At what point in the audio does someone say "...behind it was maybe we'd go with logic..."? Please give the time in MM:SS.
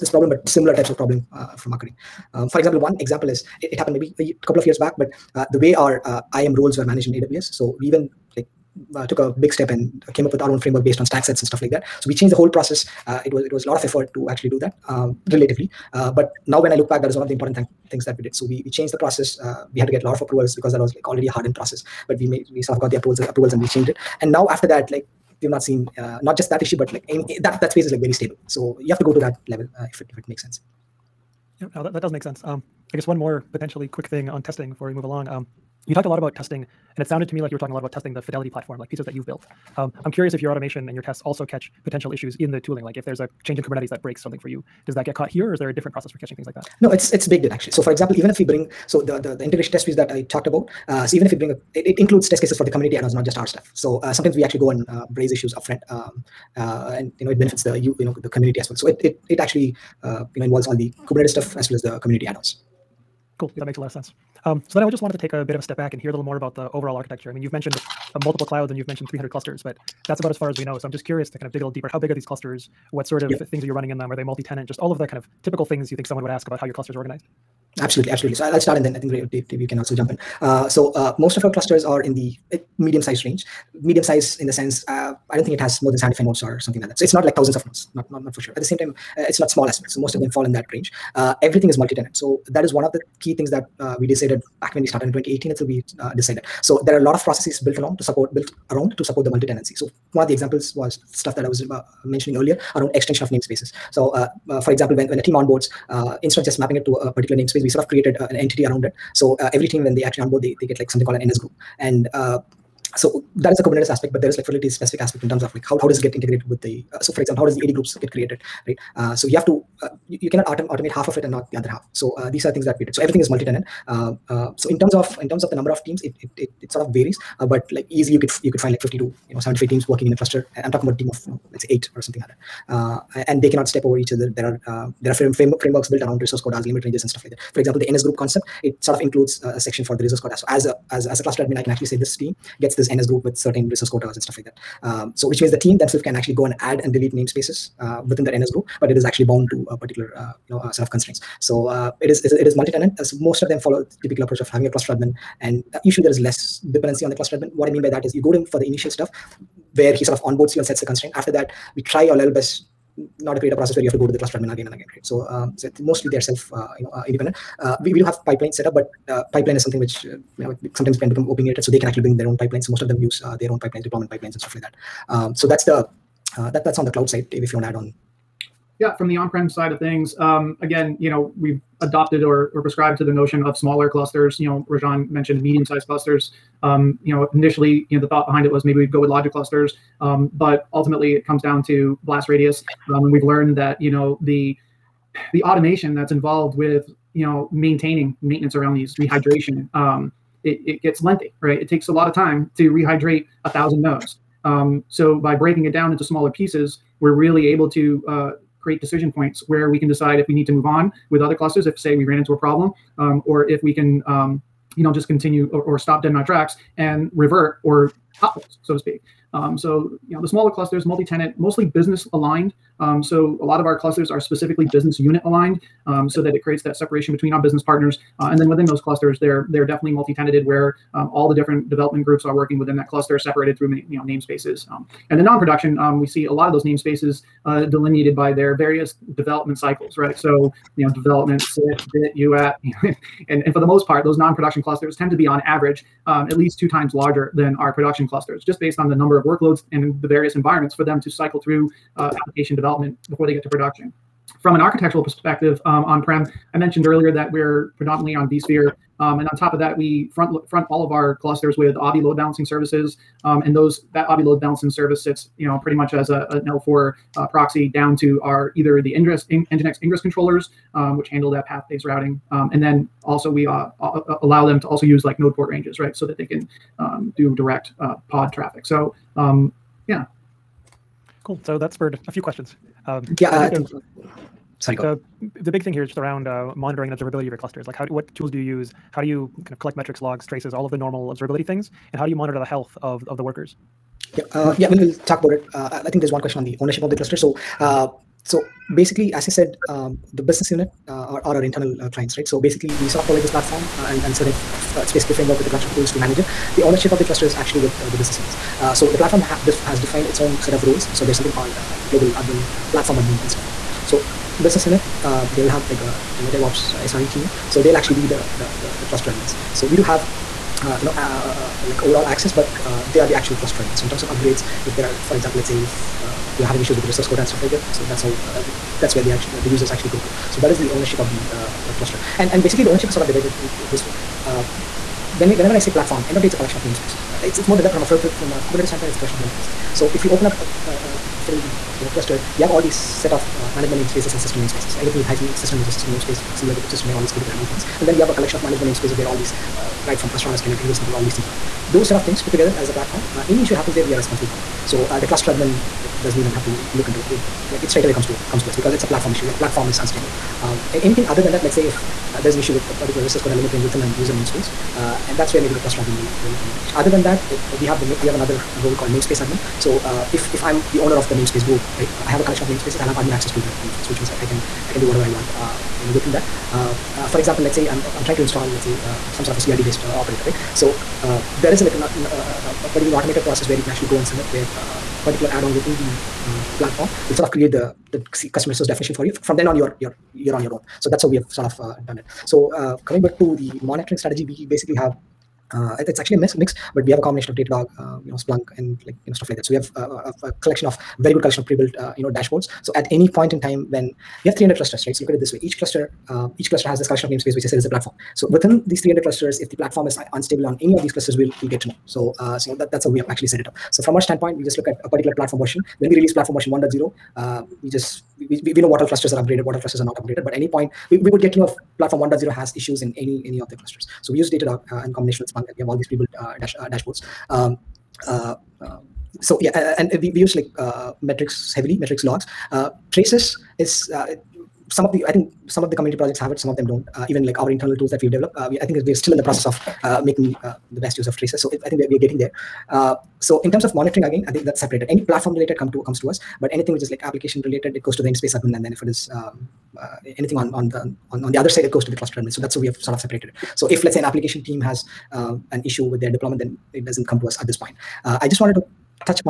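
03:08.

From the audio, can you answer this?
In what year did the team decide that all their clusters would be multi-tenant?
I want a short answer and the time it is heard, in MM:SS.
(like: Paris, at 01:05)
2018, at 01:35.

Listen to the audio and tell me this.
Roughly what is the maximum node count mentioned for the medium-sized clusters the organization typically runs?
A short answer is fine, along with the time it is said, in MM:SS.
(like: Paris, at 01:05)
75, at 01:25.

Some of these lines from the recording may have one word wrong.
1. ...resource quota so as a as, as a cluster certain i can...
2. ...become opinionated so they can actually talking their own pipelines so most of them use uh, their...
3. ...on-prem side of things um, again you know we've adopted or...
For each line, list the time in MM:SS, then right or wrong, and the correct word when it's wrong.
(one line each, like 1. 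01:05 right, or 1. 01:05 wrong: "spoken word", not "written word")
1. 02:20 wrong: "admin", not "certain"
2. 02:51 wrong: "bring", not "talking"
3. 02:59 right.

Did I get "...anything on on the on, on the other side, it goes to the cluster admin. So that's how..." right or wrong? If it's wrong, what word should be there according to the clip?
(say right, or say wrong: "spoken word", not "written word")
right.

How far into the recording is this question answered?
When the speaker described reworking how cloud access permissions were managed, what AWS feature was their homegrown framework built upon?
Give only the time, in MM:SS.
00:11.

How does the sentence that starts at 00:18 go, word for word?
So we we changed the process.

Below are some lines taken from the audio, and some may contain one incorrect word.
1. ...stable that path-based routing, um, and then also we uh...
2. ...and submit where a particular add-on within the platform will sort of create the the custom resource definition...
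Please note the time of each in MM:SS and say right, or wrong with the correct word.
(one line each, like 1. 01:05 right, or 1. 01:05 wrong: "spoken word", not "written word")
1. 04:31 wrong: "handle", not "stable"
2. 06:23 right.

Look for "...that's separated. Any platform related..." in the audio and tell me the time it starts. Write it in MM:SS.
07:24.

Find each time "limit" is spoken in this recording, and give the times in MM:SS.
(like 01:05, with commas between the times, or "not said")
02:16, 06:03.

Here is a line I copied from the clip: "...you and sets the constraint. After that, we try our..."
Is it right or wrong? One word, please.
right.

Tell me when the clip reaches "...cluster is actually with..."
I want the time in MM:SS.
05:07.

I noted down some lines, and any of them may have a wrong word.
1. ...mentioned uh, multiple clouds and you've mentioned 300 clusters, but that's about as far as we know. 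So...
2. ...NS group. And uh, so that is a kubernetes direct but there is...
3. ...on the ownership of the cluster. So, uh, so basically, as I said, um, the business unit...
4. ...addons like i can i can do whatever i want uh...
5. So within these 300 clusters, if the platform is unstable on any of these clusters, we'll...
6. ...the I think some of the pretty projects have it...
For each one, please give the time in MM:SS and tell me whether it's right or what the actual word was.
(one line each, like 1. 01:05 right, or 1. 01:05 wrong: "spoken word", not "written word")
1. 01:07 right
2. 01:51 wrong: "aspect", not "direct"
3. 04:56 right
4. 06:13 wrong: "means", not "addons"
5. 06:48 right
6. 07:14 wrong: "community", not "pretty".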